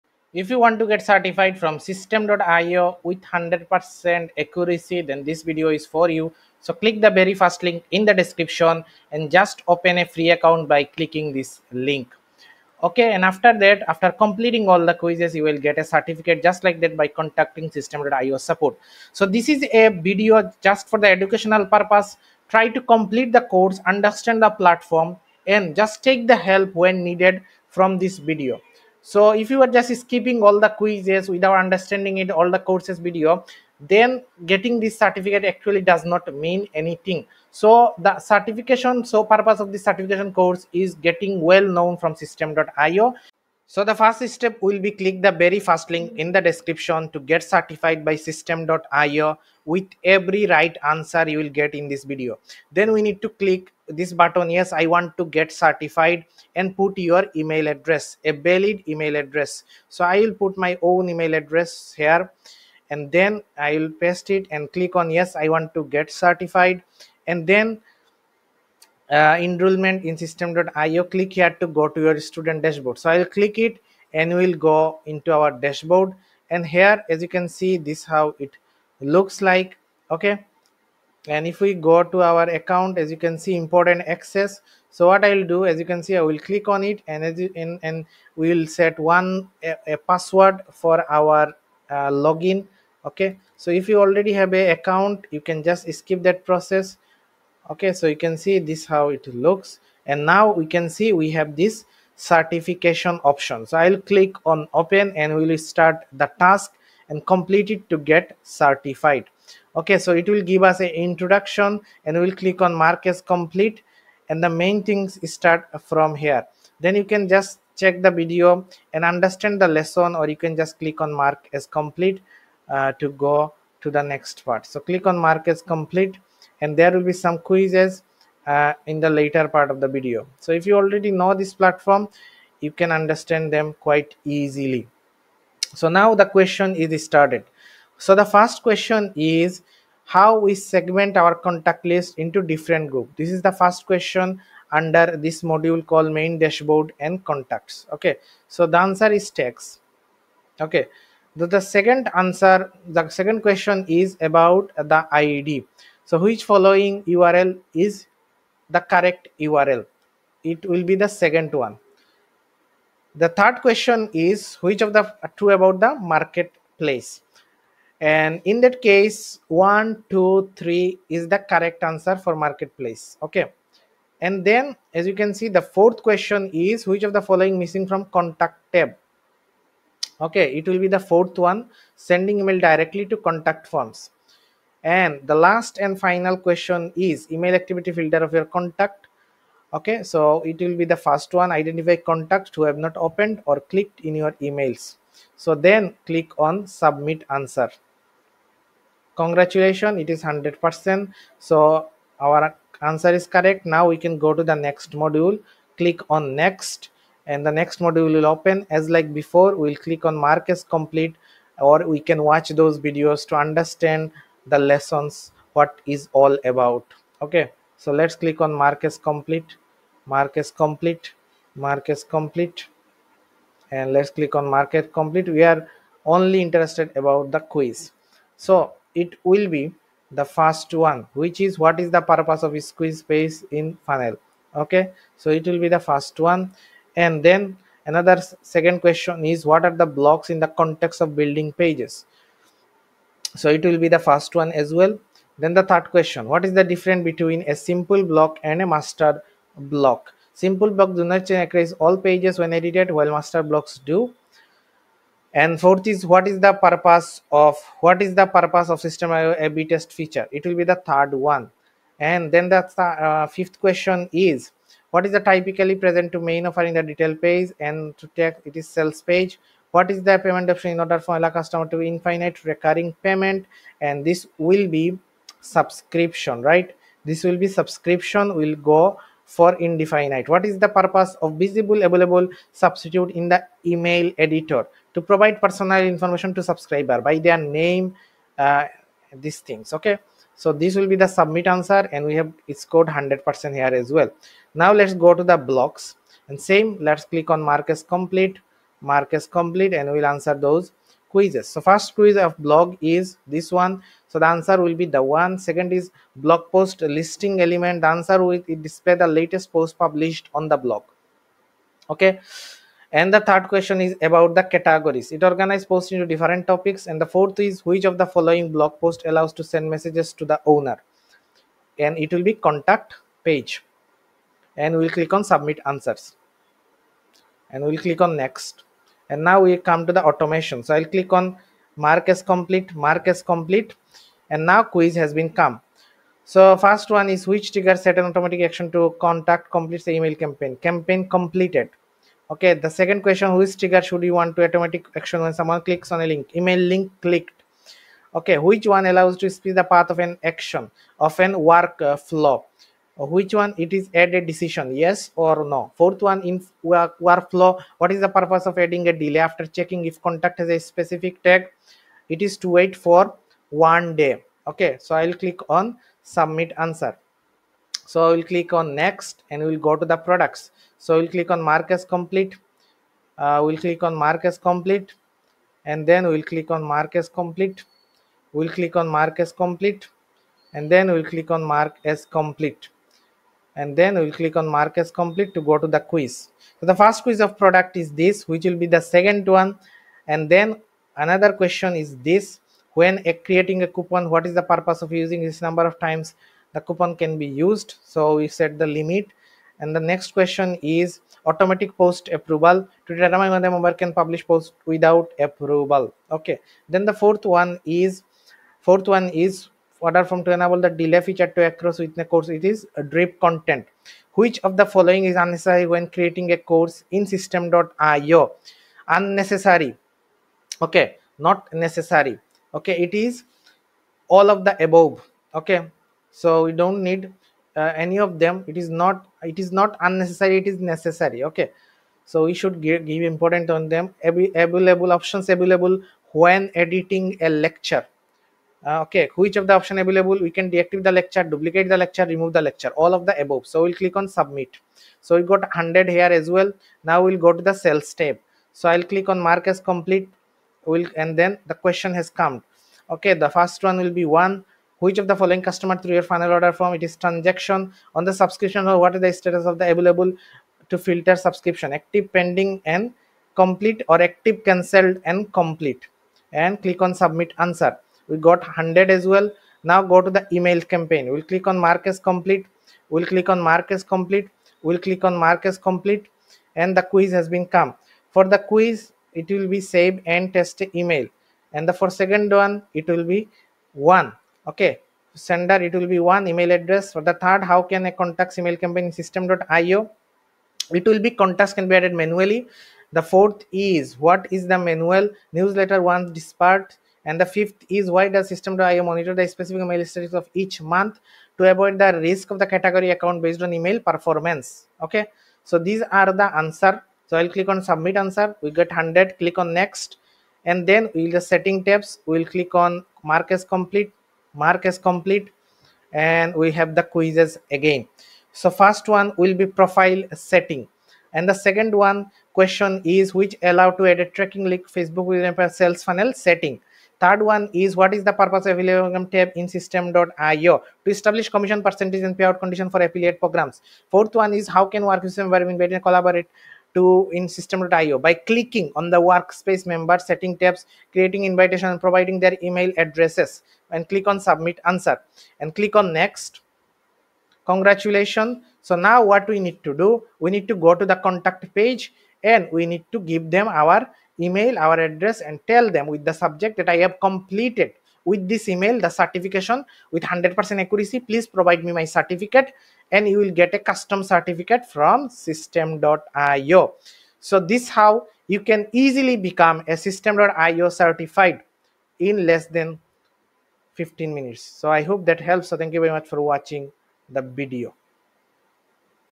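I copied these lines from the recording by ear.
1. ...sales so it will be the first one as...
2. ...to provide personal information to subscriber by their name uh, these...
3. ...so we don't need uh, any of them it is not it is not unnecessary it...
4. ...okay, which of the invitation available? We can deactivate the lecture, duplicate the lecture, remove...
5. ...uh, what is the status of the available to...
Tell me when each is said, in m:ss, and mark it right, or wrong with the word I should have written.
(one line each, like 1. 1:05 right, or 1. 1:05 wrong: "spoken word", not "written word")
1. 4:01 wrong: "pages", not "sales"
2. 4:44 right
3. 7:06 right
4. 7:18 wrong: "option", not "invitation"
5. 7:38 right.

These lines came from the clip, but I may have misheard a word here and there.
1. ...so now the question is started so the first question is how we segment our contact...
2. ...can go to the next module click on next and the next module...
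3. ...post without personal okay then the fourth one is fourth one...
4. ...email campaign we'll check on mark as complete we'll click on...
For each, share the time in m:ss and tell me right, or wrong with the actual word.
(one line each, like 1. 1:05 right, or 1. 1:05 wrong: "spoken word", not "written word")
1. 2:15 right
2. 3:23 right
3. 6:44 wrong: "approval", not "personal"
4. 7:50 wrong: "click", not "check".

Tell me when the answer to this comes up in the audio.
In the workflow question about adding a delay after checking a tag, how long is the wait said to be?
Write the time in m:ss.
6:03.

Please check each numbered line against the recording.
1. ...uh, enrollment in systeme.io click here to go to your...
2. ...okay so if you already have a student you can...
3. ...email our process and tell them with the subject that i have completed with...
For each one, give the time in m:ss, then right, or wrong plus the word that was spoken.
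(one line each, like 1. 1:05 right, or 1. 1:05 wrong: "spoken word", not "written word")
1. 1:09 right
2. 1:33 wrong: "account", not "student"
3. 9:14 wrong: "address", not "process".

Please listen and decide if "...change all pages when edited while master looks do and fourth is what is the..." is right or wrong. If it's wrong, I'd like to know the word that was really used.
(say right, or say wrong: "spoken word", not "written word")
wrong: "blocks", not "looks".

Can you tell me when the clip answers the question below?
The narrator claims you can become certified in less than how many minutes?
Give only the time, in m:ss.
9:33.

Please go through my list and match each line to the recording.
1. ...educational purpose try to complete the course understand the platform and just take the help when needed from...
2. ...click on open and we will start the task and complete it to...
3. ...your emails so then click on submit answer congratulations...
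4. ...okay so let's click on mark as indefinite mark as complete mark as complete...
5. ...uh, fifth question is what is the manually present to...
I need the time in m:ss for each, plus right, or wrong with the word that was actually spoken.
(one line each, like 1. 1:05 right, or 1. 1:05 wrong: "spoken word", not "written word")
1. 0:21 right
2. 1:44 right
3. 3:14 right
4. 3:37 wrong: "complete", not "indefinite"
5. 4:22 wrong: "typically", not "manually".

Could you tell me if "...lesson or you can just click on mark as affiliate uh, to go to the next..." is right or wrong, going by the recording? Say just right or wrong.
wrong.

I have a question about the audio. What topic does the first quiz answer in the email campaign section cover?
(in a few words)
Save and test email.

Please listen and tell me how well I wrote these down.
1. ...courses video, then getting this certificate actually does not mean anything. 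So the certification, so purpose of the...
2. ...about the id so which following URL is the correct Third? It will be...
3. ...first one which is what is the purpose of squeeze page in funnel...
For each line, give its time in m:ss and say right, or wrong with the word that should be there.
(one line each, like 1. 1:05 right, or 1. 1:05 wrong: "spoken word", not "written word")
1. 0:32 right
2. 2:34 wrong: "URL", not "Third"
3. 3:50 right.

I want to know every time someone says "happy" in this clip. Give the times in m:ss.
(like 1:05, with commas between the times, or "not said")
not said.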